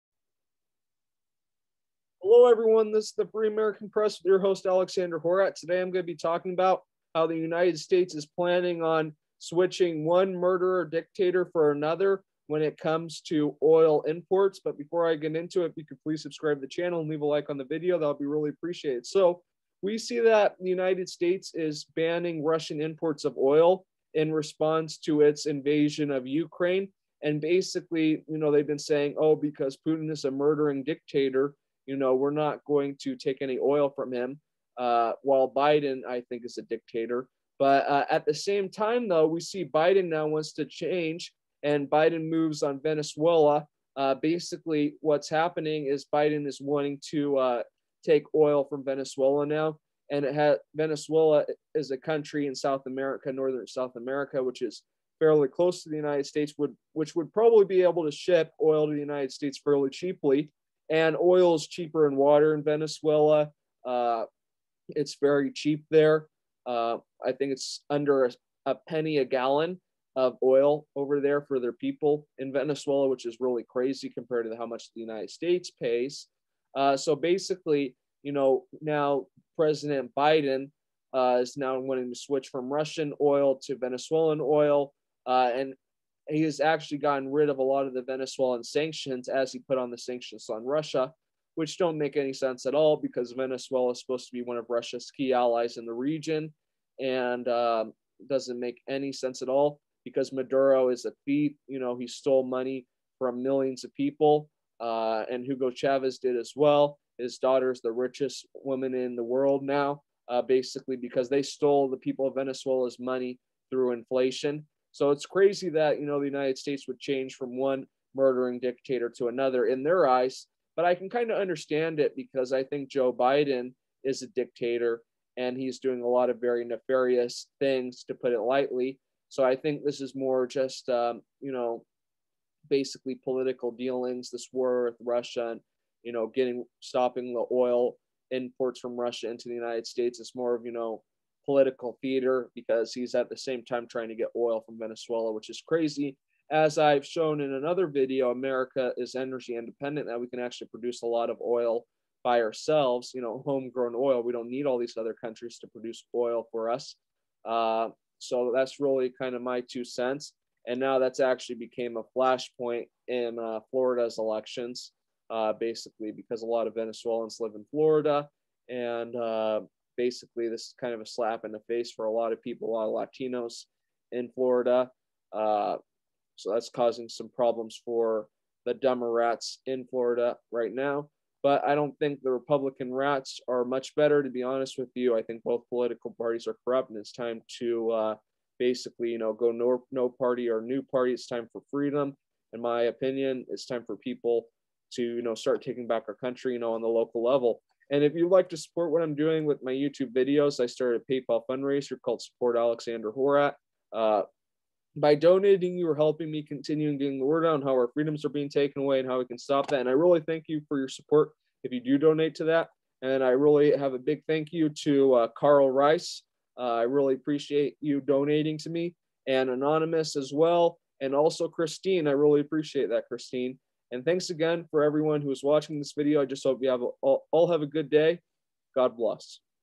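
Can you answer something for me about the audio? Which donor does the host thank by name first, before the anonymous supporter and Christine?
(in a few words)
Carl Rice.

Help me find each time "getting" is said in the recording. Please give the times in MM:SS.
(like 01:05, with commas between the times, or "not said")
02:16, 03:26.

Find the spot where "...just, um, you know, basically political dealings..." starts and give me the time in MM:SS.
02:10.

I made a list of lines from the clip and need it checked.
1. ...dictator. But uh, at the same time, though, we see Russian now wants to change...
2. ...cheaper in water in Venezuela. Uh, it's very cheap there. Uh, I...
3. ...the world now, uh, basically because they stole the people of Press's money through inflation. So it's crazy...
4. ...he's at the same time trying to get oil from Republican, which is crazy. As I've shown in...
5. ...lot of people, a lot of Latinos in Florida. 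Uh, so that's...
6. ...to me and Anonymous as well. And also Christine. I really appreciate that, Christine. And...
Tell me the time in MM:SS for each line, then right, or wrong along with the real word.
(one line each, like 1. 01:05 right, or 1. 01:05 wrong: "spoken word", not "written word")
1. 00:36 wrong: "Biden", not "Russian"
2. 01:01 right
3. 01:49 wrong: "Venezuela", not "Press"
4. 02:22 wrong: "Venezuela", not "Republican"
5. 02:52 right
6. 03:38 right.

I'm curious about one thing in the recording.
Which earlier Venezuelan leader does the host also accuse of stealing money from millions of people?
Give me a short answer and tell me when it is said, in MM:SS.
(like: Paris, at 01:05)
Hugo Chavez, at 01:45.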